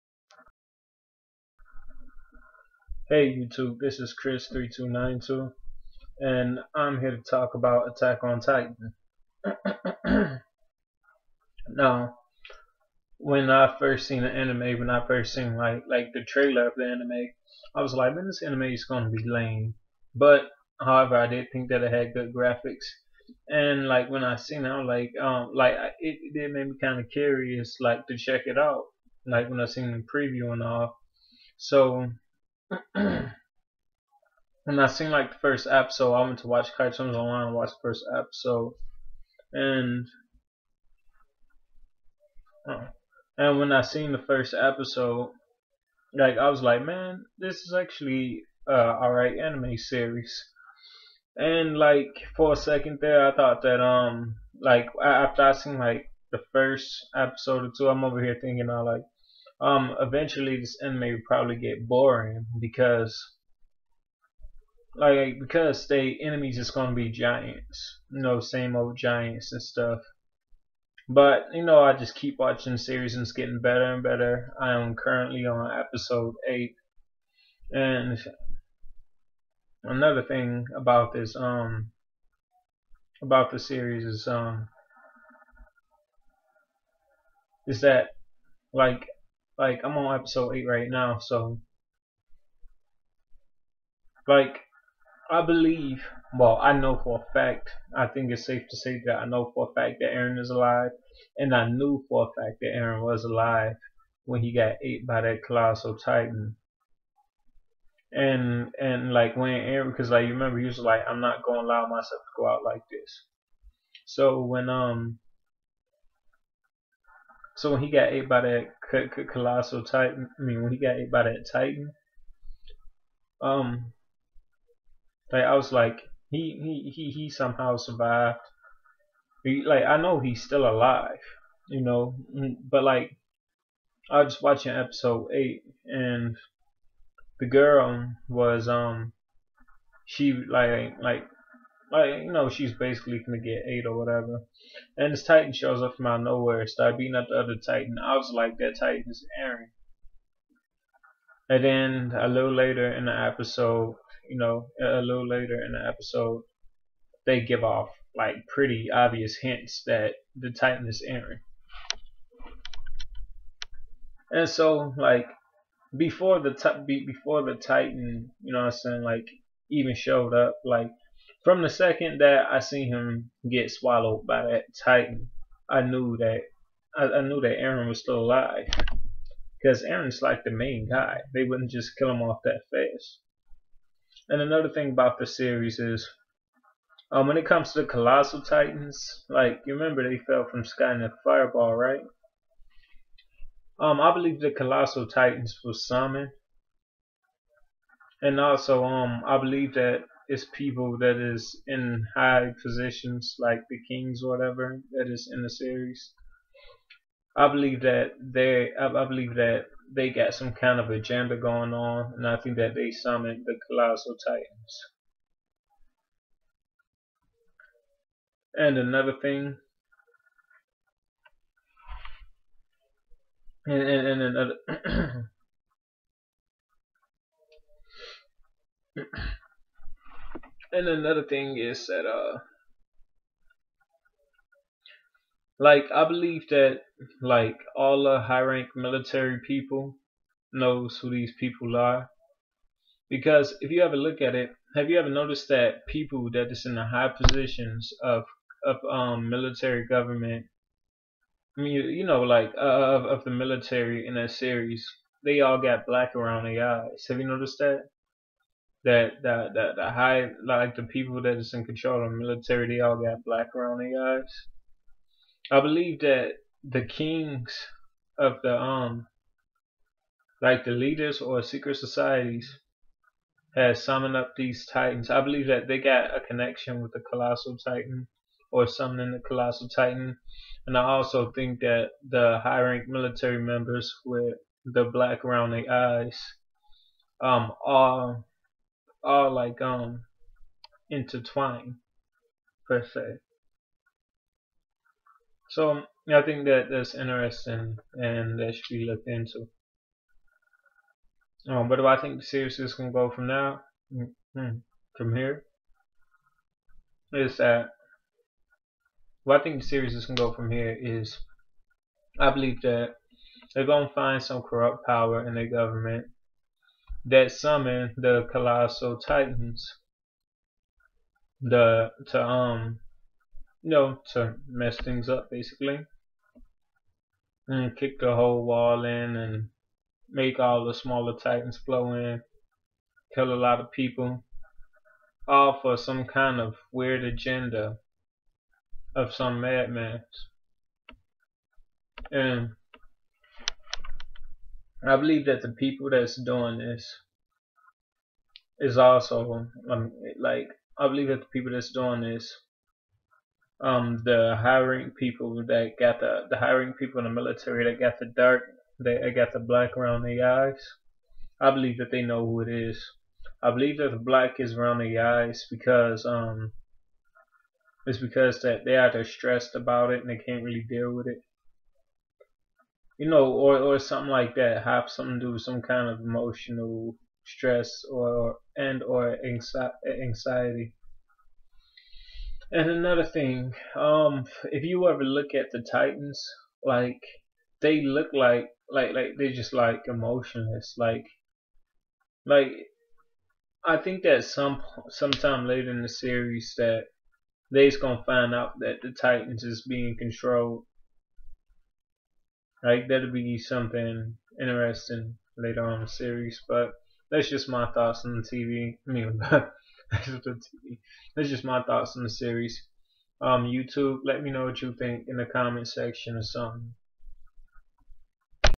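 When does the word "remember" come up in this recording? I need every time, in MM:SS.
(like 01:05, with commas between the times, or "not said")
01:50, 03:09.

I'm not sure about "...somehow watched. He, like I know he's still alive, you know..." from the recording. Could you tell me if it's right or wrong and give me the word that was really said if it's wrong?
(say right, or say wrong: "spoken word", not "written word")
wrong: "survived", not "watched".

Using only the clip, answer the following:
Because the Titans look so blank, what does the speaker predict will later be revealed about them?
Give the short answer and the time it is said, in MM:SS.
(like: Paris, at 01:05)
being controlled, at 06:39.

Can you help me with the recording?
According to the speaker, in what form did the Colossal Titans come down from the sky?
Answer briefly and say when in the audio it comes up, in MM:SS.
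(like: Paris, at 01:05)
a fireball, at 03:11.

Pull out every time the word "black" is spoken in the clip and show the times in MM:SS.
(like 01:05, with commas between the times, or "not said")
04:15, 04:23, 04:44, 05:59, 06:04.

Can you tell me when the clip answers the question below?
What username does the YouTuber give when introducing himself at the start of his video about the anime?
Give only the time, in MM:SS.
00:04.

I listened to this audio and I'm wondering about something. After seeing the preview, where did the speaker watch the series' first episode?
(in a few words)
cartoons online.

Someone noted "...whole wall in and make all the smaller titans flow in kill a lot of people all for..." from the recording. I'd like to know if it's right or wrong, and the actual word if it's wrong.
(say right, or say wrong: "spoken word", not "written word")
right.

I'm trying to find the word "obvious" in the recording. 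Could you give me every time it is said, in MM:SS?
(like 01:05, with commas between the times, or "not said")
02:38.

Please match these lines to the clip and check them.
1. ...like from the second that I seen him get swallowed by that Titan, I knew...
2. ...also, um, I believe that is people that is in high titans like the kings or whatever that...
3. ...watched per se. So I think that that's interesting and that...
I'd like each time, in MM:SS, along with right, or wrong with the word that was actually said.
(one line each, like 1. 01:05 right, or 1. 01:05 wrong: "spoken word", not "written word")
1. 02:50 right
2. 03:18 wrong: "positions", not "titans"
3. 04:50 wrong: "intertwined", not "watched".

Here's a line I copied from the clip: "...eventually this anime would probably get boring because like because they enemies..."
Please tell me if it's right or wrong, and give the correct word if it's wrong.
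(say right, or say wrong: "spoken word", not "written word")
right.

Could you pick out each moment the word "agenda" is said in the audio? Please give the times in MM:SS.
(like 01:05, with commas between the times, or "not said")
03:30, 05:37.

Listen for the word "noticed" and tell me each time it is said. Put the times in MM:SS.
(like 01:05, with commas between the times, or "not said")
04:05, 04:17.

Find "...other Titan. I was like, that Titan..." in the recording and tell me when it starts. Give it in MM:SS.
02:27.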